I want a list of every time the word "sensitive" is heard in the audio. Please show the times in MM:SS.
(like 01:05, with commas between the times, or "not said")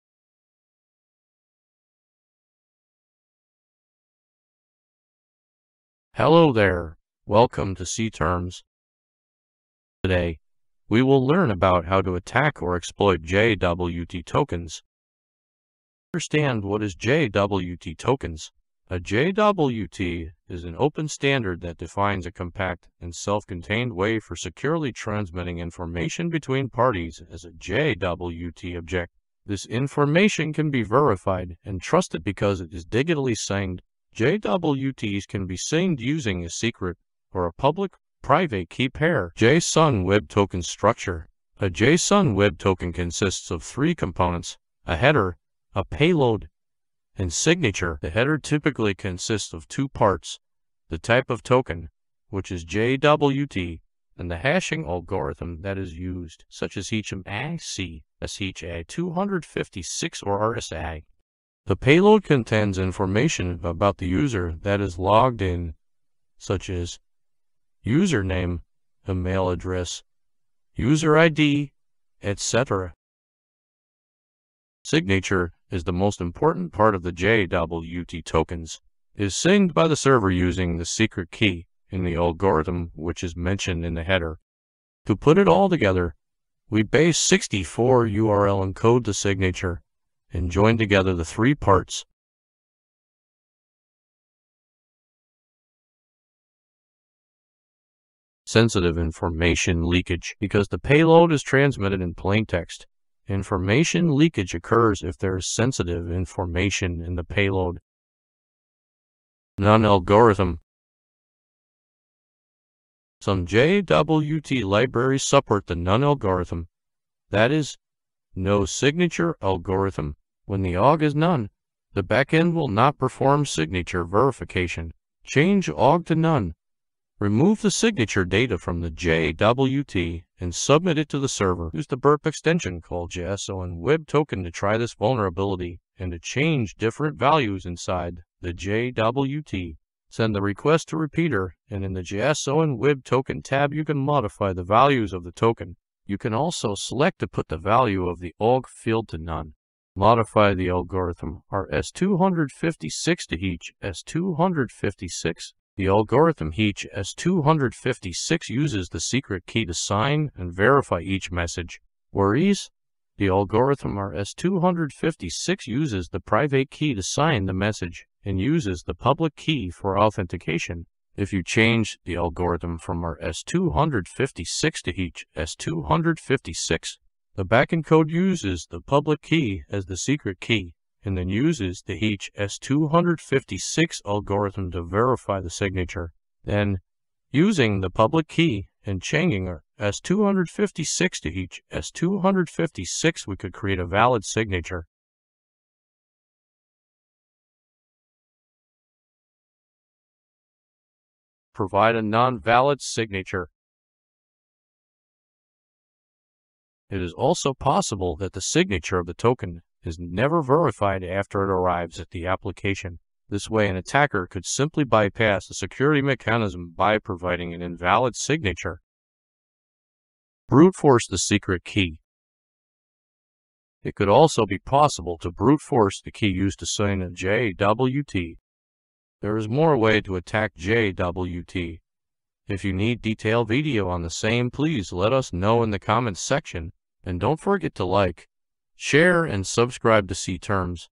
01:38, 01:45.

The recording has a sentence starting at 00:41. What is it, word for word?
A JSON web token consists of three components, a header, a payload, and signature.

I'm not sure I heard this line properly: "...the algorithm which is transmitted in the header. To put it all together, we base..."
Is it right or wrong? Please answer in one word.
wrong.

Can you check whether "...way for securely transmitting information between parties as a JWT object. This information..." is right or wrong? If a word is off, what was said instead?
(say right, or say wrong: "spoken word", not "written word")
right.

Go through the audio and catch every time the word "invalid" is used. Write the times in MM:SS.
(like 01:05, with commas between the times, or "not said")
03:37.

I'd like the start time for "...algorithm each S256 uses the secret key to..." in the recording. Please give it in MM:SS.
02:35.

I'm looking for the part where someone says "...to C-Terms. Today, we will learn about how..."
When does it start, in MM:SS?
00:07.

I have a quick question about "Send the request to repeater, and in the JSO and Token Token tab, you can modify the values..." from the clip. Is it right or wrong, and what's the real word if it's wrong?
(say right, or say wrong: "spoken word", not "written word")
wrong: "Web", not "Token".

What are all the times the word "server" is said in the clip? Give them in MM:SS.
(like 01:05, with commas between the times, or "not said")
01:19, 02:11.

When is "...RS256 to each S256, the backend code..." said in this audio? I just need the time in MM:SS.
02:53.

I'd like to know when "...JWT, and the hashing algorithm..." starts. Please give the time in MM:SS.
00:52.